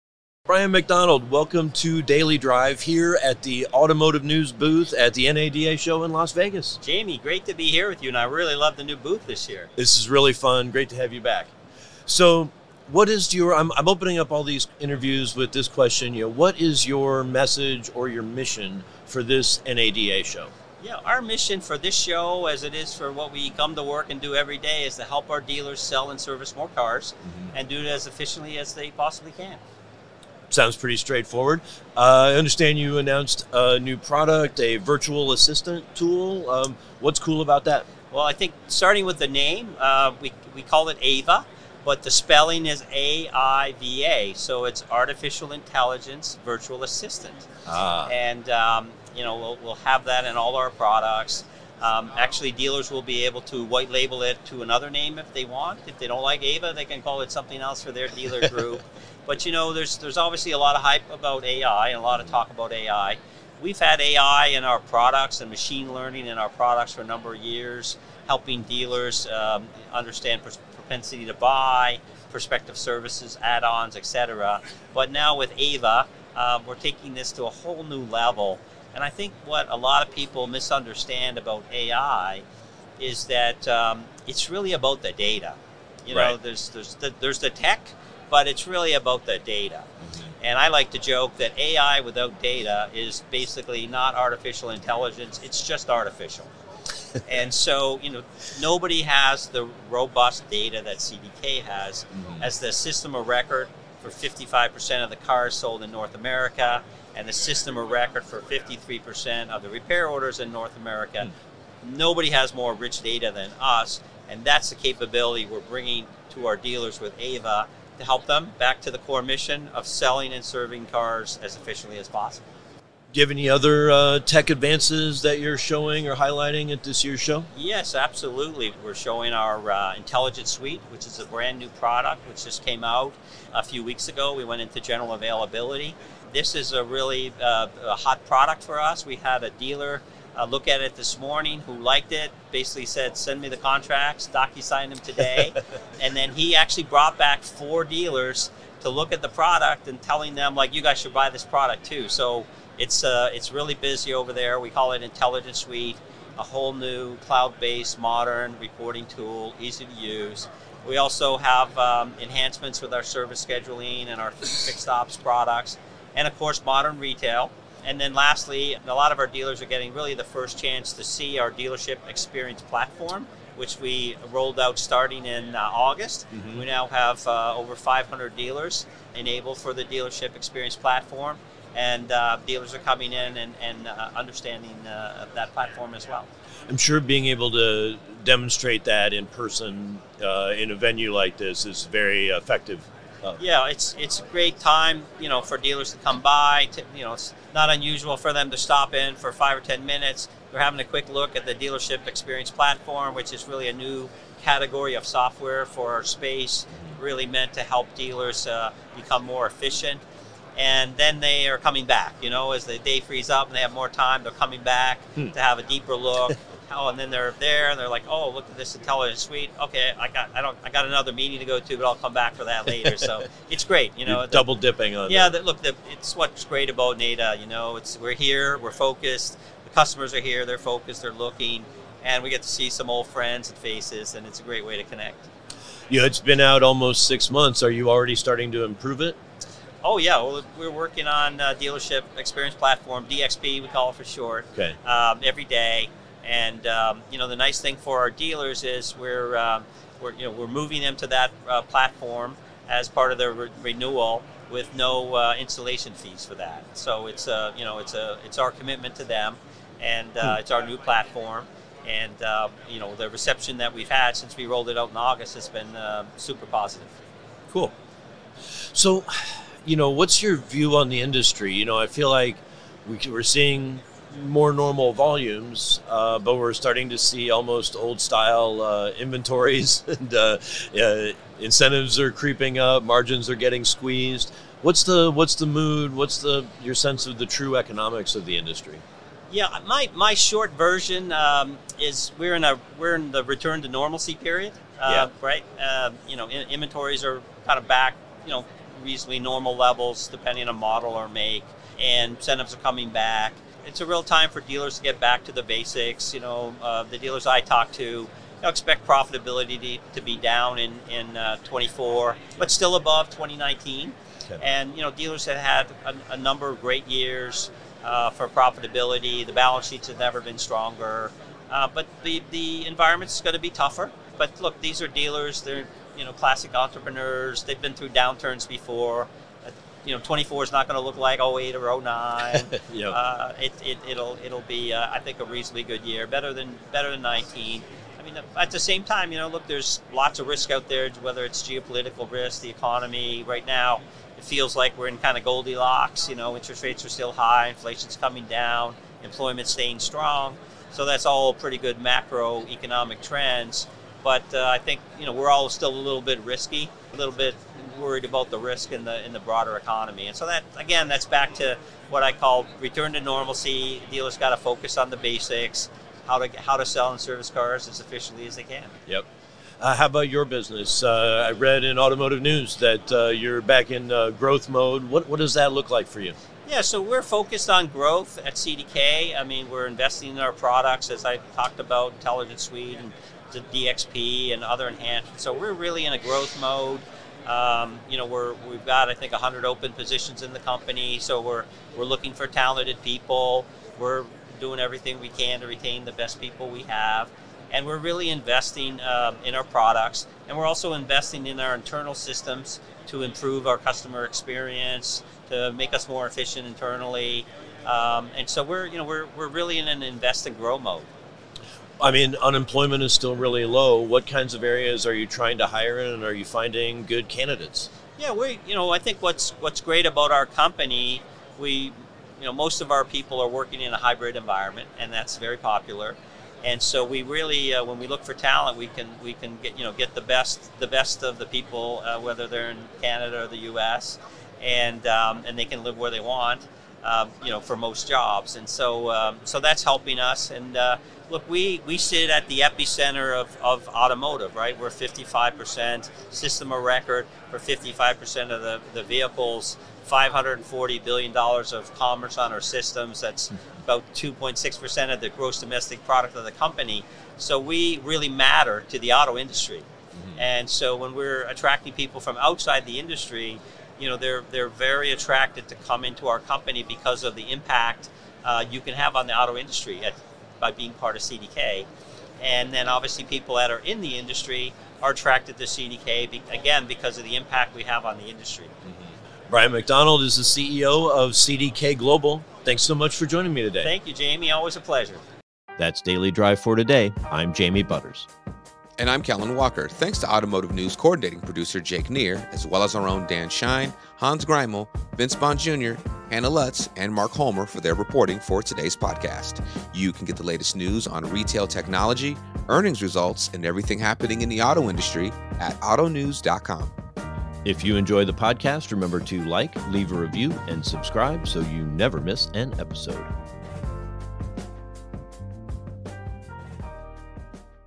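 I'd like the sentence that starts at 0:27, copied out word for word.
and do it as efficiently as they possibly can.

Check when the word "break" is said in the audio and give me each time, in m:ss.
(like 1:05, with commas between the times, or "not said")
not said.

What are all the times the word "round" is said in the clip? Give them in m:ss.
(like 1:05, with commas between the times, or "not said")
not said.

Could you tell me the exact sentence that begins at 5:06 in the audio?
You know, uh, the dealers I talk to expect profitability to, be down in in uh, 24, but still above 2019.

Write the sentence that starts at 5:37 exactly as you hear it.
I mean, at the same time, you know, look, there's lots of risk out there, whether it's geopolitical risk, the economy.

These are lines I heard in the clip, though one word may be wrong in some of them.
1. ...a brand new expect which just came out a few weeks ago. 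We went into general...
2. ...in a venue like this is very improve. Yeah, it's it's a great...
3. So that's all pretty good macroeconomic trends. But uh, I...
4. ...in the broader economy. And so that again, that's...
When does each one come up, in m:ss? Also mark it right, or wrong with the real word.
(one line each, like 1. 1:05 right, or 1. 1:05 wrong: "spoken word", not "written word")
1. 2:11 wrong: "product", not "expect"
2. 3:10 wrong: "effective", not "improve"
3. 5:50 right
4. 5:59 right.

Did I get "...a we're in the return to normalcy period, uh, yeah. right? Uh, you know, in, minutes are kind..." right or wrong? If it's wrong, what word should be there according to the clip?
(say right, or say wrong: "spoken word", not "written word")
wrong: "inventories", not "minutes".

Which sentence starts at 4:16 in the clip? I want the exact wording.
So it's a you know it's a it's our commitment to them, and uh, hmm.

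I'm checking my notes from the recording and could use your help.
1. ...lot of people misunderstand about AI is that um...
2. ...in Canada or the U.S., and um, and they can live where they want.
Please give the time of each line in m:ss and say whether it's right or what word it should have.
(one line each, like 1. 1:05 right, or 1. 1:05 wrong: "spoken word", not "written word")
1. 1:19 right
2. 7:12 right.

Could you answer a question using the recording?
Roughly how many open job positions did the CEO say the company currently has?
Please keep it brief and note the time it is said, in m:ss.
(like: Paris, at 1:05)
100, at 6:29.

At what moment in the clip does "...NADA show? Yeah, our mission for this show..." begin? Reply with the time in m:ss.
0:19.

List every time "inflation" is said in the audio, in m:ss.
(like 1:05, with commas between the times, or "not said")
5:47.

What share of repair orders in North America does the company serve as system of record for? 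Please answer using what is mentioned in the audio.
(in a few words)
53%.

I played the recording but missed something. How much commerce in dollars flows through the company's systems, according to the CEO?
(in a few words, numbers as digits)
$540 billion.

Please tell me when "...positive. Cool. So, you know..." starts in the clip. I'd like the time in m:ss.
4:26.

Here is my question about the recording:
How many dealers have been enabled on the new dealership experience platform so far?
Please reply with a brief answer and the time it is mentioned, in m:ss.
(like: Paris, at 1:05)
over 500, at 2:57.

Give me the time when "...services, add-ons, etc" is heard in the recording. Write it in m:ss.
1:12.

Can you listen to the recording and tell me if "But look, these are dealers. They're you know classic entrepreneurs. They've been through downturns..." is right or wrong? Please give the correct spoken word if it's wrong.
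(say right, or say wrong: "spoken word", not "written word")
right.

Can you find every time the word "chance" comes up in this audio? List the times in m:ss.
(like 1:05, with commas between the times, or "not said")
2:50.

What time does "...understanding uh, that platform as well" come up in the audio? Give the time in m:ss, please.
3:04.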